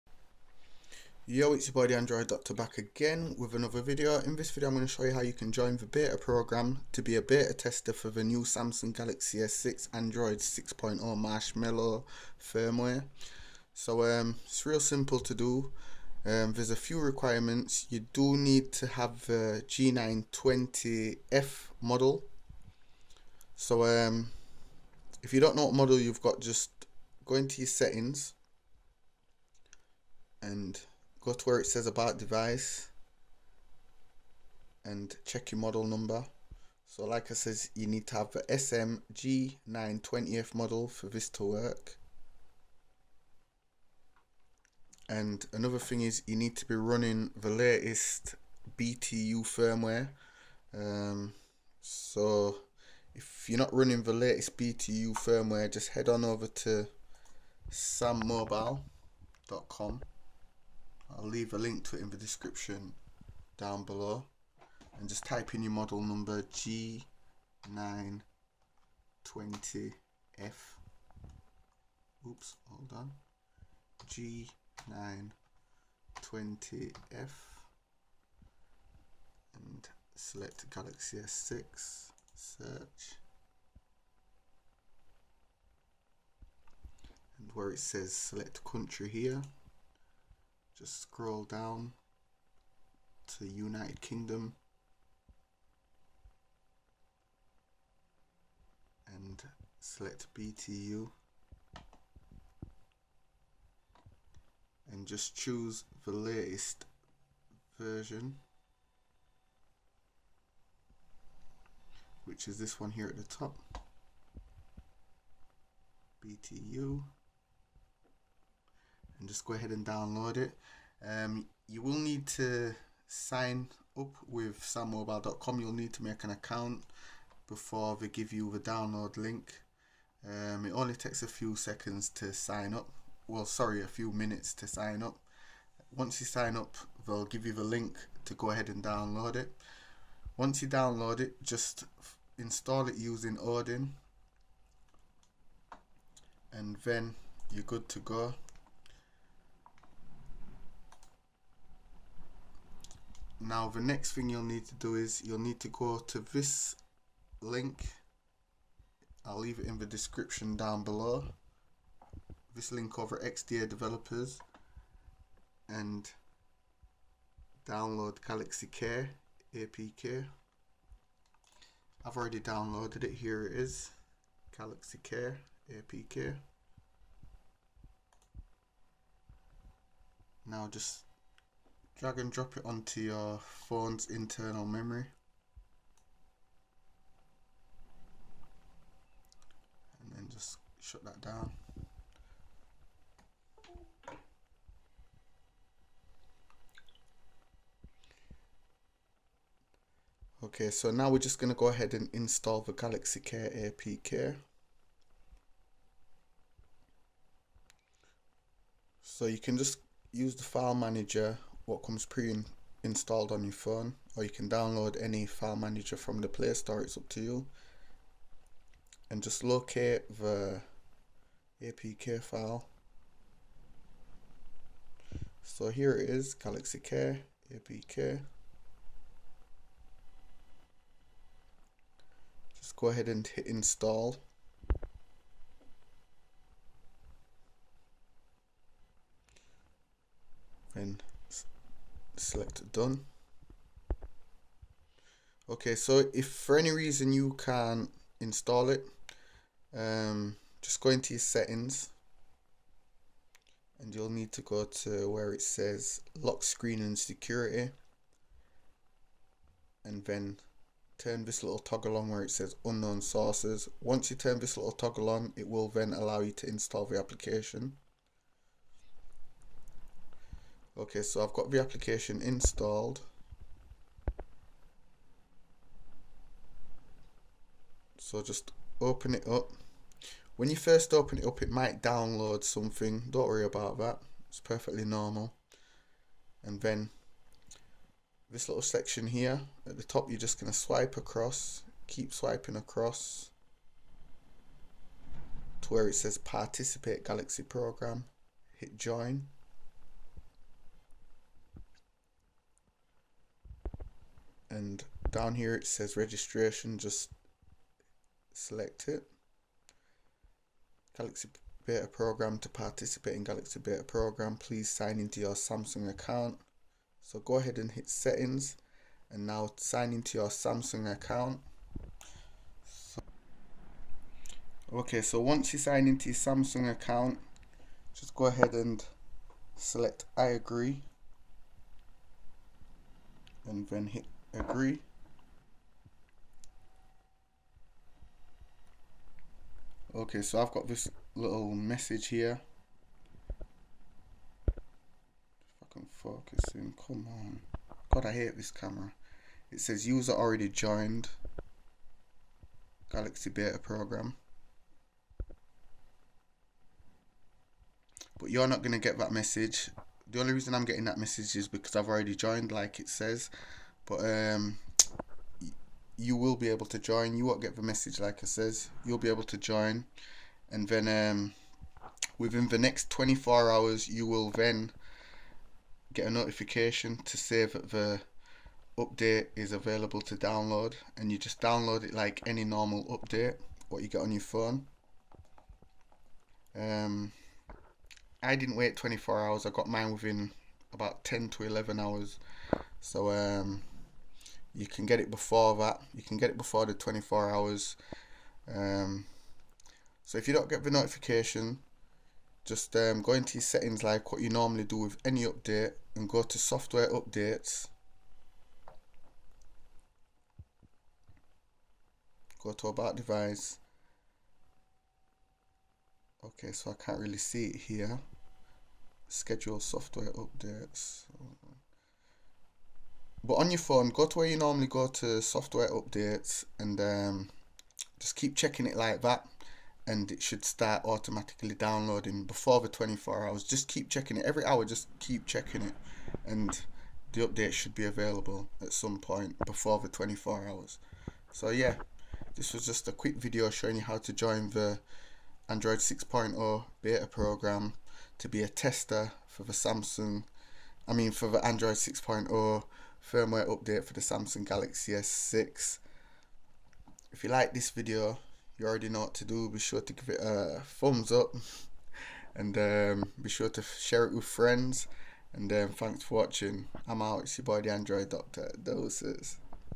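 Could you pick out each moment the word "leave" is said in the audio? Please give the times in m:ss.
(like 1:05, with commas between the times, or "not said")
1:01, 2:39.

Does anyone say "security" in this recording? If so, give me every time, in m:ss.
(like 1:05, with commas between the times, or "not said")
4:16.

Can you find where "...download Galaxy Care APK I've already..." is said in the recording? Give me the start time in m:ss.
2:47.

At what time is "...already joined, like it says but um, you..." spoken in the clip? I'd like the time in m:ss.
6:01.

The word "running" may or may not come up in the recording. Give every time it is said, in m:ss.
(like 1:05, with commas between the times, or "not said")
0:46, 0:53.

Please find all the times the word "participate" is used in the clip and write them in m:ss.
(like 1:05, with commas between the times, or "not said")
4:56, 5:12.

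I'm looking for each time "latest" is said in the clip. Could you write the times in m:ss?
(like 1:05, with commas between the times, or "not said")
0:47, 0:54, 1:46.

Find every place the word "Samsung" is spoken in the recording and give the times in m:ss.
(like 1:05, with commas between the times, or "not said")
0:08, 5:15, 5:20, 5:26, 7:29, 7:34.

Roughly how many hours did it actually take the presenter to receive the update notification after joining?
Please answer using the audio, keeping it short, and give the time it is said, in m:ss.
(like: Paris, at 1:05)
10 to 11 hours, at 6:31.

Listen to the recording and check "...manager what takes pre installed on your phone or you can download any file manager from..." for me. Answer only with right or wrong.
wrong.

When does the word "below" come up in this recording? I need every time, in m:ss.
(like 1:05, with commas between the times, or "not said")
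1:03, 2:40.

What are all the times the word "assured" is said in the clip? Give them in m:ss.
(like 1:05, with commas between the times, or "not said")
not said.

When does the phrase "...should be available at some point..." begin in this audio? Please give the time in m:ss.
7:17.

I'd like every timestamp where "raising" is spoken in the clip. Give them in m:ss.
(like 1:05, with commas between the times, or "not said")
not said.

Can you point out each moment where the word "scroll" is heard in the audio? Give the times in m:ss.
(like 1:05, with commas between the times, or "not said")
1:31.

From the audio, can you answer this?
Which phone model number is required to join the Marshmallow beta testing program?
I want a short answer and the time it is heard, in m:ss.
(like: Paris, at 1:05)
SM-G920F, at 0:38.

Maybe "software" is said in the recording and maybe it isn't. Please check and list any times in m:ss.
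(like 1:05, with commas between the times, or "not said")
6:46, 6:59, 7:05.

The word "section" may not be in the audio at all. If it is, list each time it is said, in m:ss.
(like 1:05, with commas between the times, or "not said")
4:48.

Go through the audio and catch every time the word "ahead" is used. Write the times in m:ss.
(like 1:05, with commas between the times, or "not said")
1:59, 2:18, 3:21, 3:52, 5:17, 5:28.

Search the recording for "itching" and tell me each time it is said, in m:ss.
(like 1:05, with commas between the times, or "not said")
not said.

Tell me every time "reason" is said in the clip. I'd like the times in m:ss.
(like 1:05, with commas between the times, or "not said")
4:06, 6:00.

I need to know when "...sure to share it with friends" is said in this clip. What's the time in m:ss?
7:43.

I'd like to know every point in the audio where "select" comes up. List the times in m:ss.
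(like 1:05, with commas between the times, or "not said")
1:20, 1:28, 1:39, 4:02, 5:08, 5:29.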